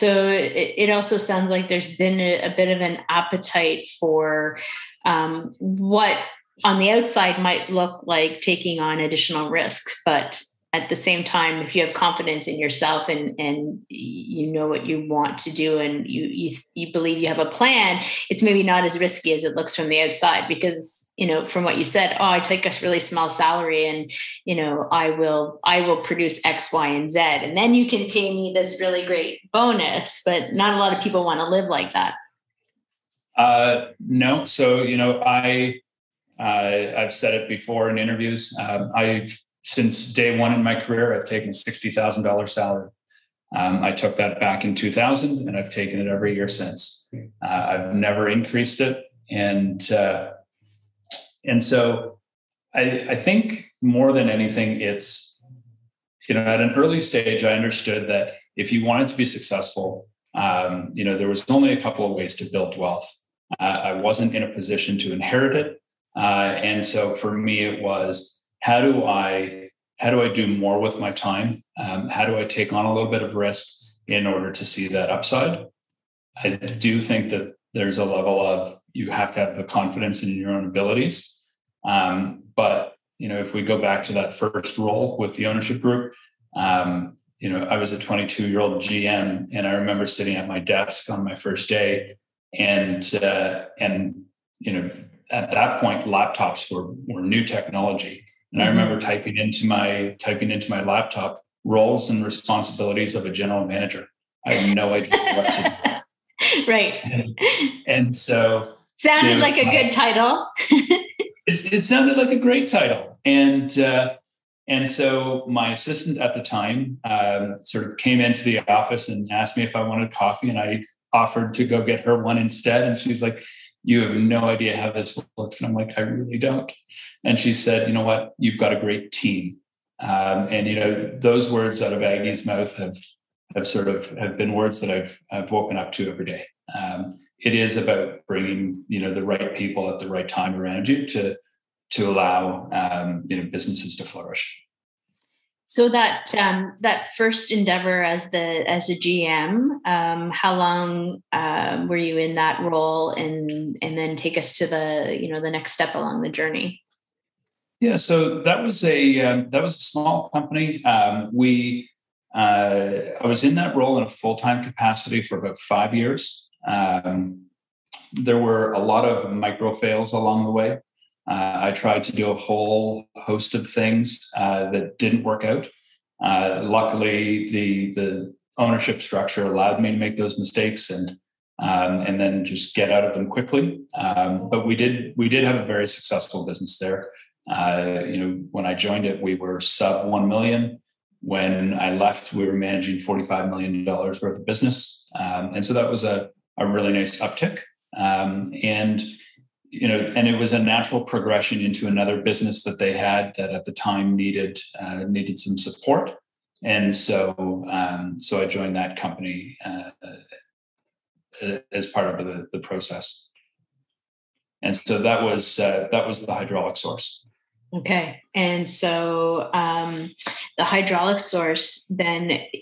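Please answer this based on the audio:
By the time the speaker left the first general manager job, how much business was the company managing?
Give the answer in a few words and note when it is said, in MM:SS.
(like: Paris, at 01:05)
$45 million, at 03:12.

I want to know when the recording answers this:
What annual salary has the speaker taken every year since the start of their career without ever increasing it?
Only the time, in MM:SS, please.
00:41.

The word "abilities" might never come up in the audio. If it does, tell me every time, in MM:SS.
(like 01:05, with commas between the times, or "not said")
01:20.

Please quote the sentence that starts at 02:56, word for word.
Uh, luckily, the the ownership structure allowed me to make those mistakes and um, and then just get out of them quickly.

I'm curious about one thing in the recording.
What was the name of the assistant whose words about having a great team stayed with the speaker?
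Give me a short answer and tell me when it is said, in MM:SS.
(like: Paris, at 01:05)
Aggie, at 02:12.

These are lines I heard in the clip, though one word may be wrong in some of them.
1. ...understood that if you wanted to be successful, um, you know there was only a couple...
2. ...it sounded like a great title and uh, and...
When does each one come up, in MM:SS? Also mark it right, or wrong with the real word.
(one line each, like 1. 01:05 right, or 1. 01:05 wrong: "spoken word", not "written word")
1. 00:57 right
2. 01:51 right.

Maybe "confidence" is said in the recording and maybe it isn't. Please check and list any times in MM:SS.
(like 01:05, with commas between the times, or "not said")
00:11, 01:19.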